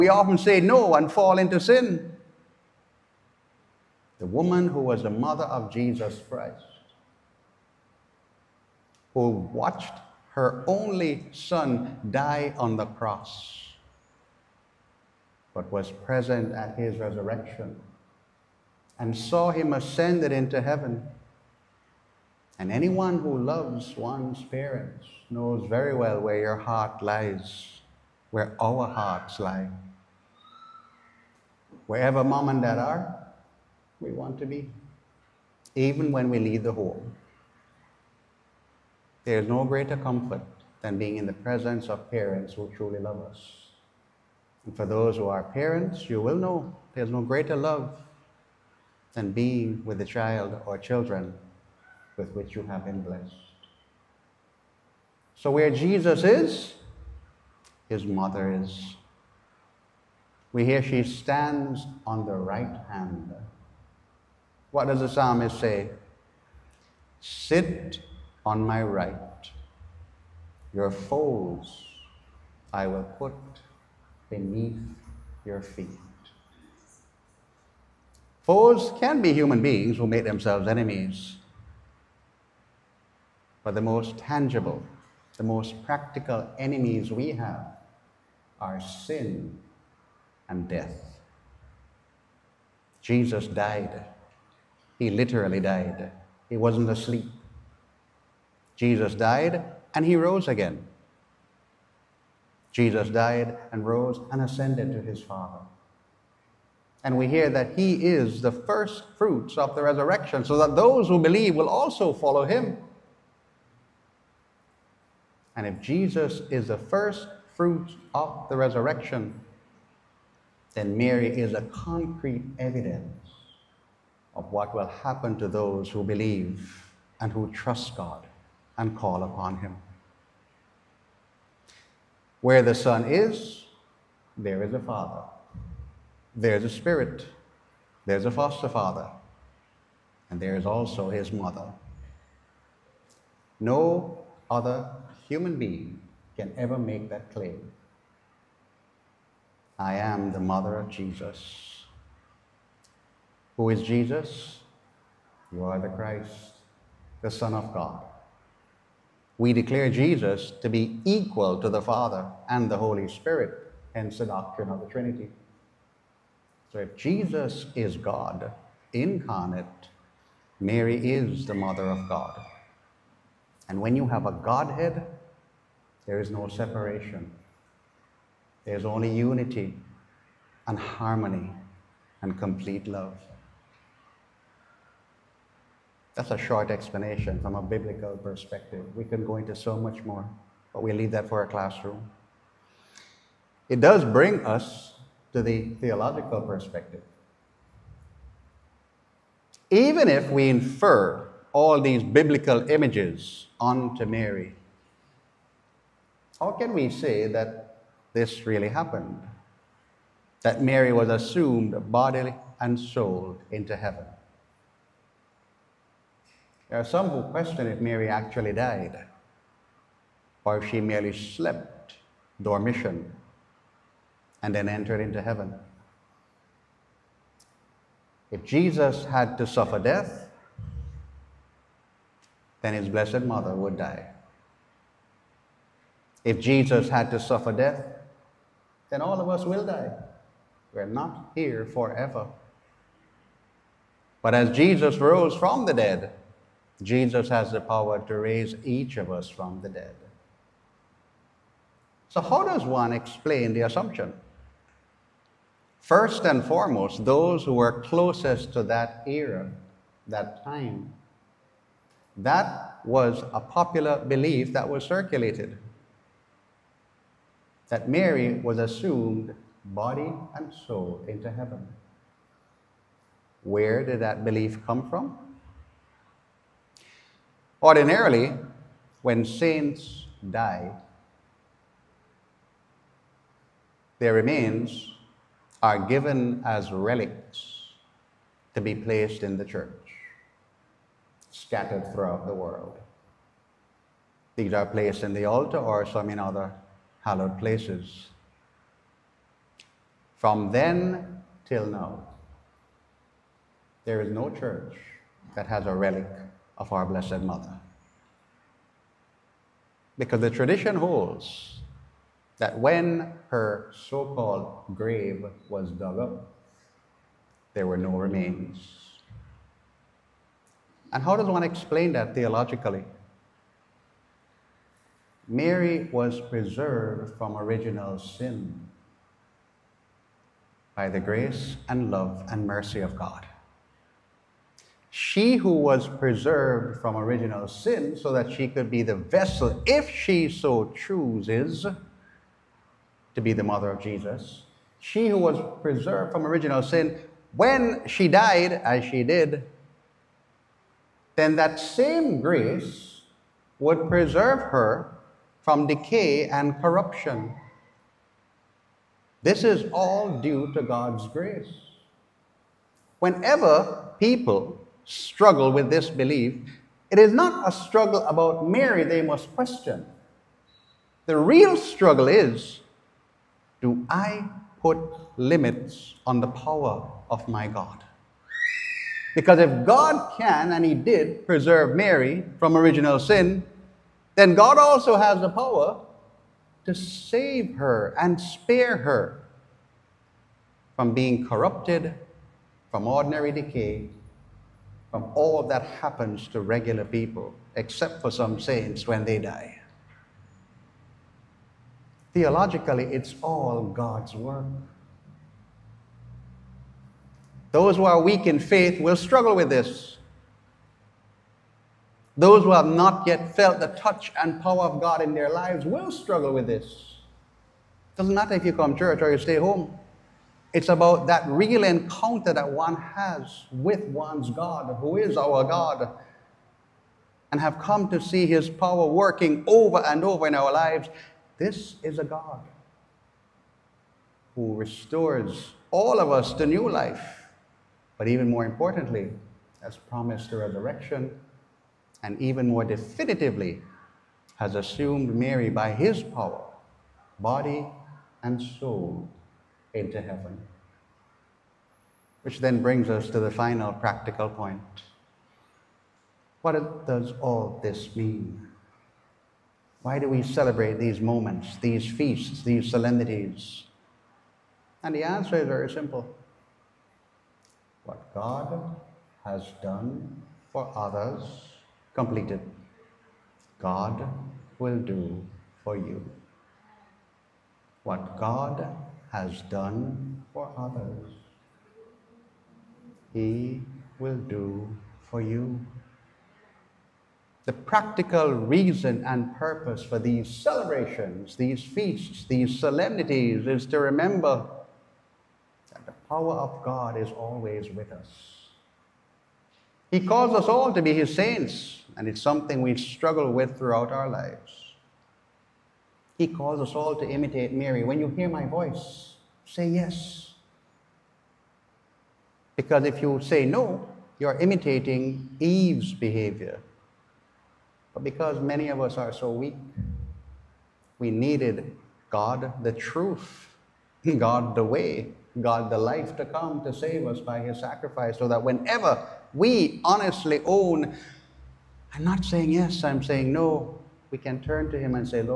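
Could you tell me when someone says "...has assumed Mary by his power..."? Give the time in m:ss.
7:24.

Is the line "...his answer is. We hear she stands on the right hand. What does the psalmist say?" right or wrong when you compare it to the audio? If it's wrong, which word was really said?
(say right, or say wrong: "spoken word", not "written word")
wrong: "mother", not "answer".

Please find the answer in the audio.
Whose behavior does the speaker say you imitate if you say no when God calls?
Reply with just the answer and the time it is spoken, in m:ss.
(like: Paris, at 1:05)
Eve, at 8:35.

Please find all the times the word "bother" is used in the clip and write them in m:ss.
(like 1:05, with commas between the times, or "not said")
not said.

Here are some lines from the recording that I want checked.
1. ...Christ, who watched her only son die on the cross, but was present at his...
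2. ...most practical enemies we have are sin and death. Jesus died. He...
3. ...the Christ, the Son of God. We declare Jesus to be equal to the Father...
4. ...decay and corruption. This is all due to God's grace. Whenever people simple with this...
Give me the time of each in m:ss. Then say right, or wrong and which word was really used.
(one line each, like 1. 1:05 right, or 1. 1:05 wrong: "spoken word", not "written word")
1. 0:06 right
2. 1:25 right
3. 2:35 right
4. 5:55 wrong: "struggle", not "simple".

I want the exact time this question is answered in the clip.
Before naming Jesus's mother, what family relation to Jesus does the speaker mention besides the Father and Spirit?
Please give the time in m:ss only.
2:18.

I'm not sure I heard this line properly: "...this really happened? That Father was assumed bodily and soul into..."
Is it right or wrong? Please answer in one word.
wrong.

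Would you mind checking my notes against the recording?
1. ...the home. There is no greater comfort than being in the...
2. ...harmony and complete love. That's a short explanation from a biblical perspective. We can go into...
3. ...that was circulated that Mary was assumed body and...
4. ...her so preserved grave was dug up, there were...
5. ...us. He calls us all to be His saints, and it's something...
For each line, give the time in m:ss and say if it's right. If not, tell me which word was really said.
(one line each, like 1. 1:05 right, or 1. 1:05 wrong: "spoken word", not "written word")
1. 0:36 right
2. 3:00 right
3. 4:24 right
4. 5:13 wrong: "called", not "preserved"
5. 8:17 right.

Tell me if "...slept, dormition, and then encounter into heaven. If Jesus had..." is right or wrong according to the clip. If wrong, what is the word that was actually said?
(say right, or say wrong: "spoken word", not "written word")
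wrong: "enter", not "encounter".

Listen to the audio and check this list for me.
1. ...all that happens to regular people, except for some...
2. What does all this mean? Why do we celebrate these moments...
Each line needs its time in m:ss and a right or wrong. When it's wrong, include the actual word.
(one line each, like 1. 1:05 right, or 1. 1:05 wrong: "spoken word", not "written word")
1. 6:35 right
2. 7:36 right.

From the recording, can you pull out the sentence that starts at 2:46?
So if Jesus is God incarnate, Mary is the mother of God.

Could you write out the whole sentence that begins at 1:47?
And we hear that he is the first fruits of the resurrection, so that those who believe will also follow him.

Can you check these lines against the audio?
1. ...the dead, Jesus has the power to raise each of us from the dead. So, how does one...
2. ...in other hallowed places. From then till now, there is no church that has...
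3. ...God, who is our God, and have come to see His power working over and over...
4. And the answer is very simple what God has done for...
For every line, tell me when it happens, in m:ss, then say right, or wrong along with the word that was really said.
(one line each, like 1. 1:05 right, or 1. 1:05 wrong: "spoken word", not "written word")
1. 4:05 right
2. 4:56 right
3. 7:04 right
4. 7:44 right.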